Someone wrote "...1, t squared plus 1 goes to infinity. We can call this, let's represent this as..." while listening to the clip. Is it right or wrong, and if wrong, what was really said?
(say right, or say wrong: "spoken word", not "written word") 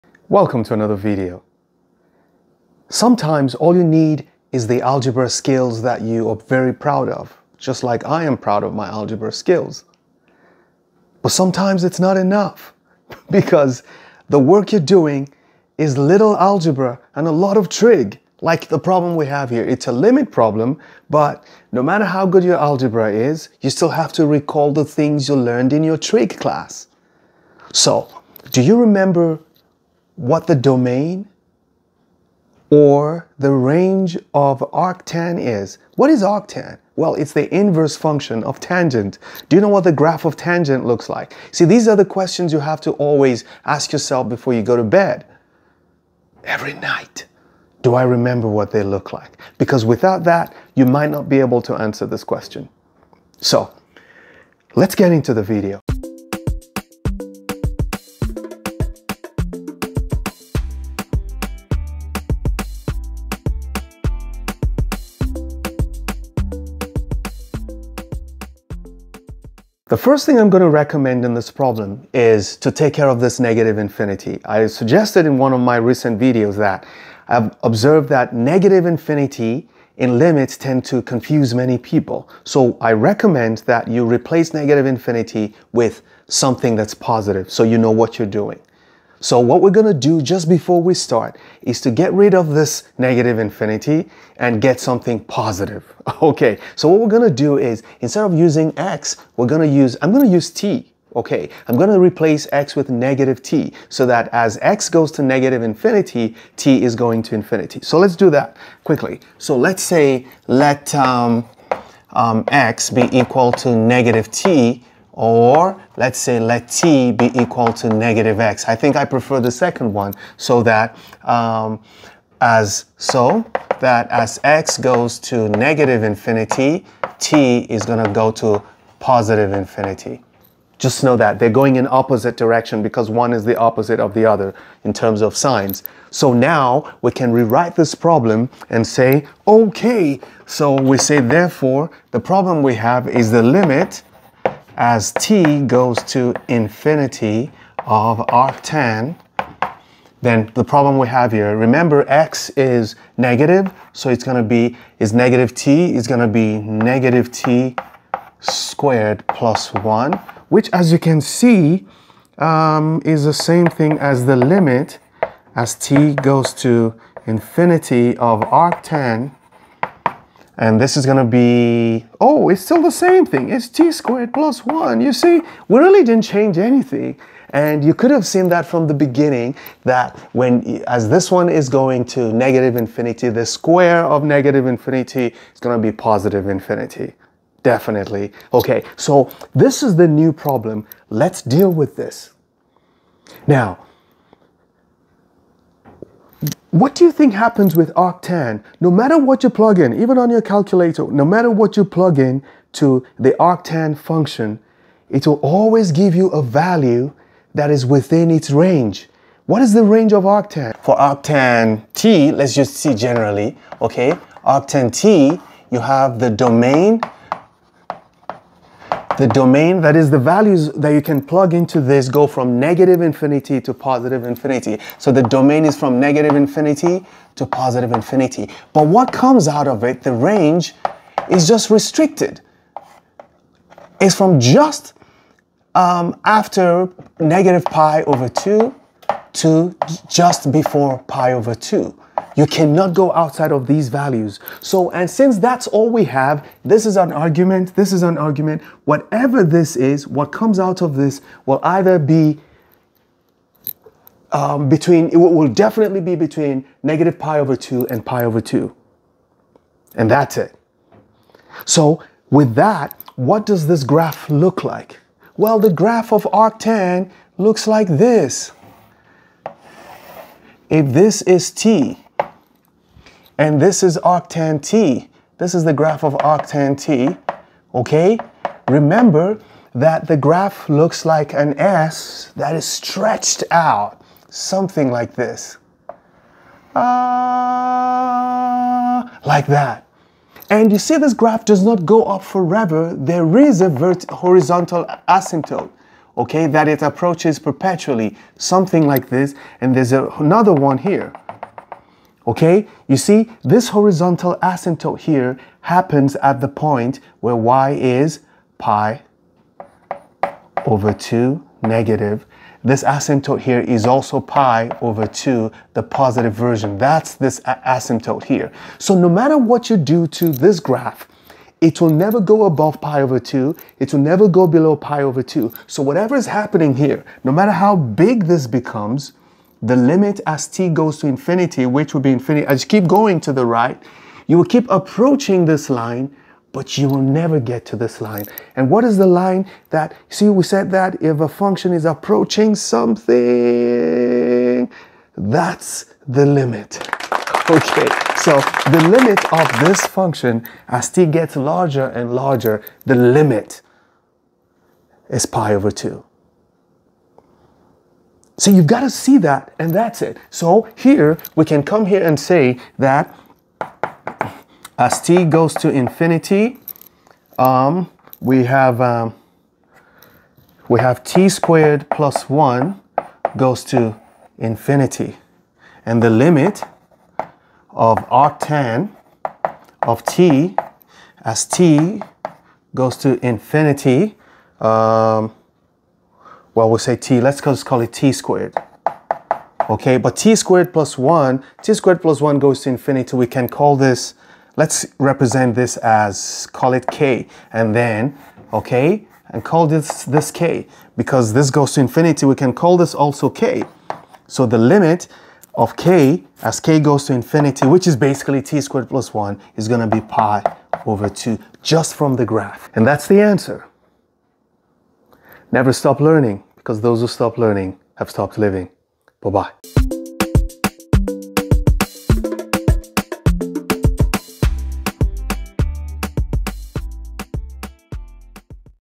right.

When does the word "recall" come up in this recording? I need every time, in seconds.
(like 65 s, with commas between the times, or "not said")
24 s.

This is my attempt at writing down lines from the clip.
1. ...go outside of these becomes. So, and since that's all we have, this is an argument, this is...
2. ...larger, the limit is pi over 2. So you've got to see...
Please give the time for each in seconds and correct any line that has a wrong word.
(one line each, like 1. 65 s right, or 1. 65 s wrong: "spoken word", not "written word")
1. 242 s wrong: "values", not "becomes"
2. 352 s right.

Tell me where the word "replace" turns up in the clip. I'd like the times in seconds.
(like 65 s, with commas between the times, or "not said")
84 s, 101 s.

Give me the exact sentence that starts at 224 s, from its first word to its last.
So the domain is from negative infinity to positive infinity.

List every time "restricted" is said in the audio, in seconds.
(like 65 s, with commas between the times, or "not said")
231 s.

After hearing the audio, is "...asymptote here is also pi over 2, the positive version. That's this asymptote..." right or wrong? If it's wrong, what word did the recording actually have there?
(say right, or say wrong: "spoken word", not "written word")
right.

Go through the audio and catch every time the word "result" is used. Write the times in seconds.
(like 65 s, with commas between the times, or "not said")
not said.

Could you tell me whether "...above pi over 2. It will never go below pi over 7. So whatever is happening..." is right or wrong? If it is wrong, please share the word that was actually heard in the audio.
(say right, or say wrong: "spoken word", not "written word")
wrong: "2", not "7".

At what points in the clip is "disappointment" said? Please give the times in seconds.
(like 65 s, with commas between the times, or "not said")
not said.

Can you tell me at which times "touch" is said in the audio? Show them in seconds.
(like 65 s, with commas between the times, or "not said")
not said.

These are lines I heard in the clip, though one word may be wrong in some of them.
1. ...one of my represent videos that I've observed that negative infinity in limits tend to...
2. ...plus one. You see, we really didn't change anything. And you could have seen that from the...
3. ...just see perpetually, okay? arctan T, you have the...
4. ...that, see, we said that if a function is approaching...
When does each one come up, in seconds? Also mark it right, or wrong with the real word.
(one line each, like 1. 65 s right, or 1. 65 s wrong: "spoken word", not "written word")
1. 75 s wrong: "recent", not "represent"
2. 174 s right
3. 212 s wrong: "generally", not "perpetually"
4. 339 s right.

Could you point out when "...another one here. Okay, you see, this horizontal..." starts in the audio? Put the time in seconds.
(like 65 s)
300 s.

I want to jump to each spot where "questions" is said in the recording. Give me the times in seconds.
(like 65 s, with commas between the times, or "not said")
42 s, 52 s.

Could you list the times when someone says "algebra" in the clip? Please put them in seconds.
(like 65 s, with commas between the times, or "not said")
4 s, 8 s, 16 s, 22 s.